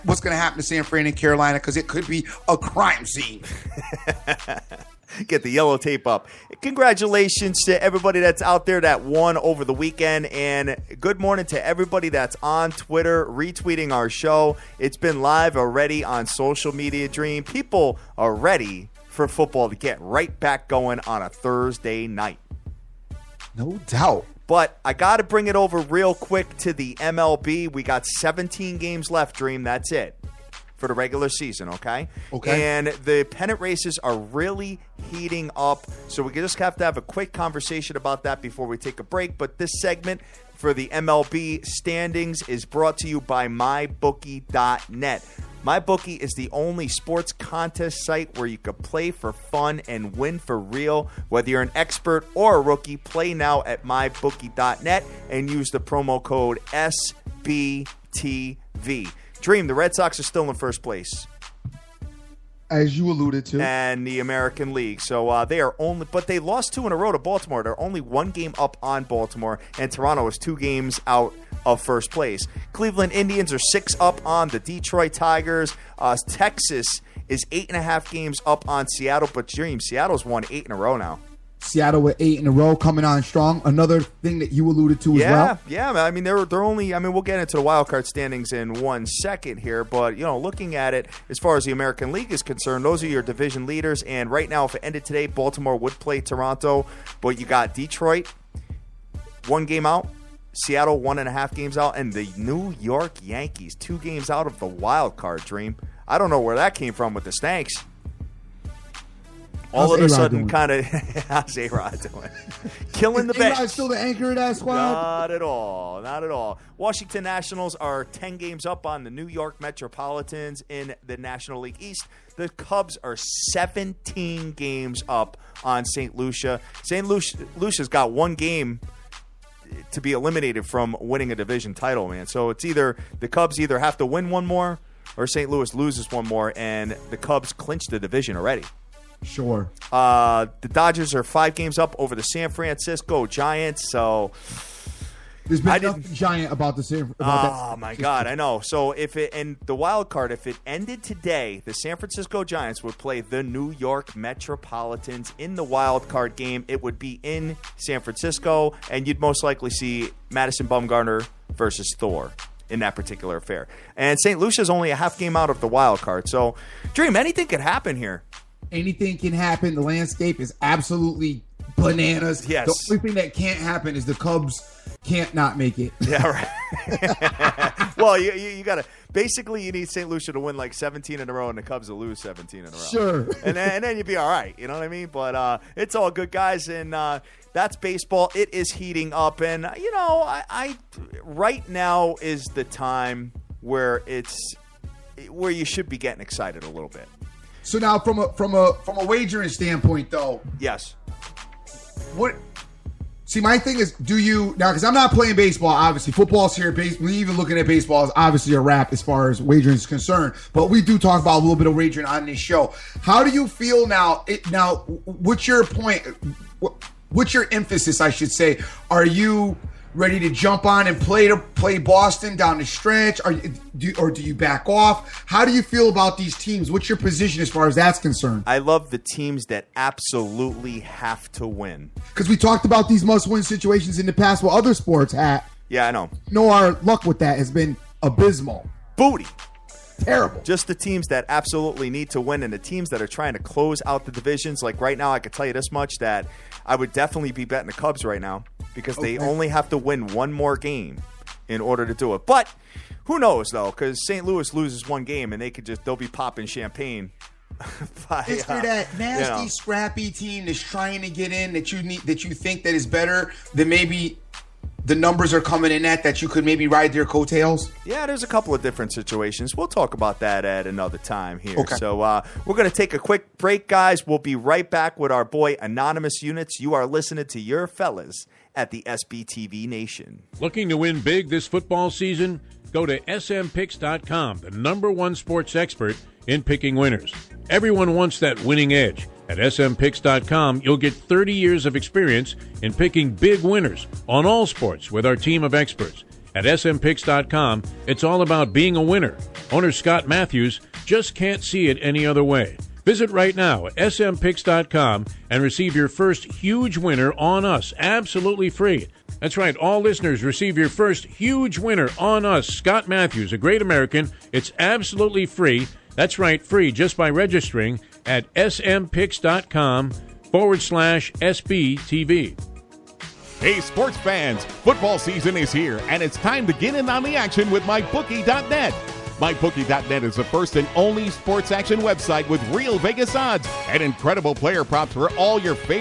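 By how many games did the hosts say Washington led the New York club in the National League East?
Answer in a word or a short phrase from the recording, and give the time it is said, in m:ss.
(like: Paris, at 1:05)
10, at 1:58.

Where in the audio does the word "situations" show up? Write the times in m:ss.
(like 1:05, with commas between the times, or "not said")
3:53, 4:28.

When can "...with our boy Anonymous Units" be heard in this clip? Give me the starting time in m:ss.
4:34.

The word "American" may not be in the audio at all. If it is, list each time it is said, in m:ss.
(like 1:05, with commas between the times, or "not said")
1:04, 1:31, 5:13.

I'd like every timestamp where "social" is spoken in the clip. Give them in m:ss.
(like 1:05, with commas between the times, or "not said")
0:16.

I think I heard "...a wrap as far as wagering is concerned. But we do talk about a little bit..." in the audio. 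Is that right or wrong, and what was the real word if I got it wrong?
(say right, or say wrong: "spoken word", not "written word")
right.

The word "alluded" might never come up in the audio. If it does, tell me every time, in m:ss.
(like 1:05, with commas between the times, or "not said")
1:03, 1:24.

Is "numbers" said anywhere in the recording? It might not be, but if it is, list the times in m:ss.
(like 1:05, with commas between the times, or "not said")
4:24, 4:44.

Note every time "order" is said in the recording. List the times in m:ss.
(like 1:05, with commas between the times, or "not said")
4:11.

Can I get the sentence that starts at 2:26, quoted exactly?
giant about the About oh that.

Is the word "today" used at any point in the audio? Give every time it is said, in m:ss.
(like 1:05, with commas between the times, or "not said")
1:35, 2:31.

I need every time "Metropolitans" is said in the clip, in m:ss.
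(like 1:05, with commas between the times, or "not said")
1:59, 2:34.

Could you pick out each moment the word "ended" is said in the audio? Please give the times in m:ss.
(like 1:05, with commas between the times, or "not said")
1:34, 2:30.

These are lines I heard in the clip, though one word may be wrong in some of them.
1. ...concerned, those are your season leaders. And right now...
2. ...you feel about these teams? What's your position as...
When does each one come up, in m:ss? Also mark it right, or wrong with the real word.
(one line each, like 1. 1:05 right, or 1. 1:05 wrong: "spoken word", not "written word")
1. 1:32 wrong: "division", not "season"
2. 3:45 right.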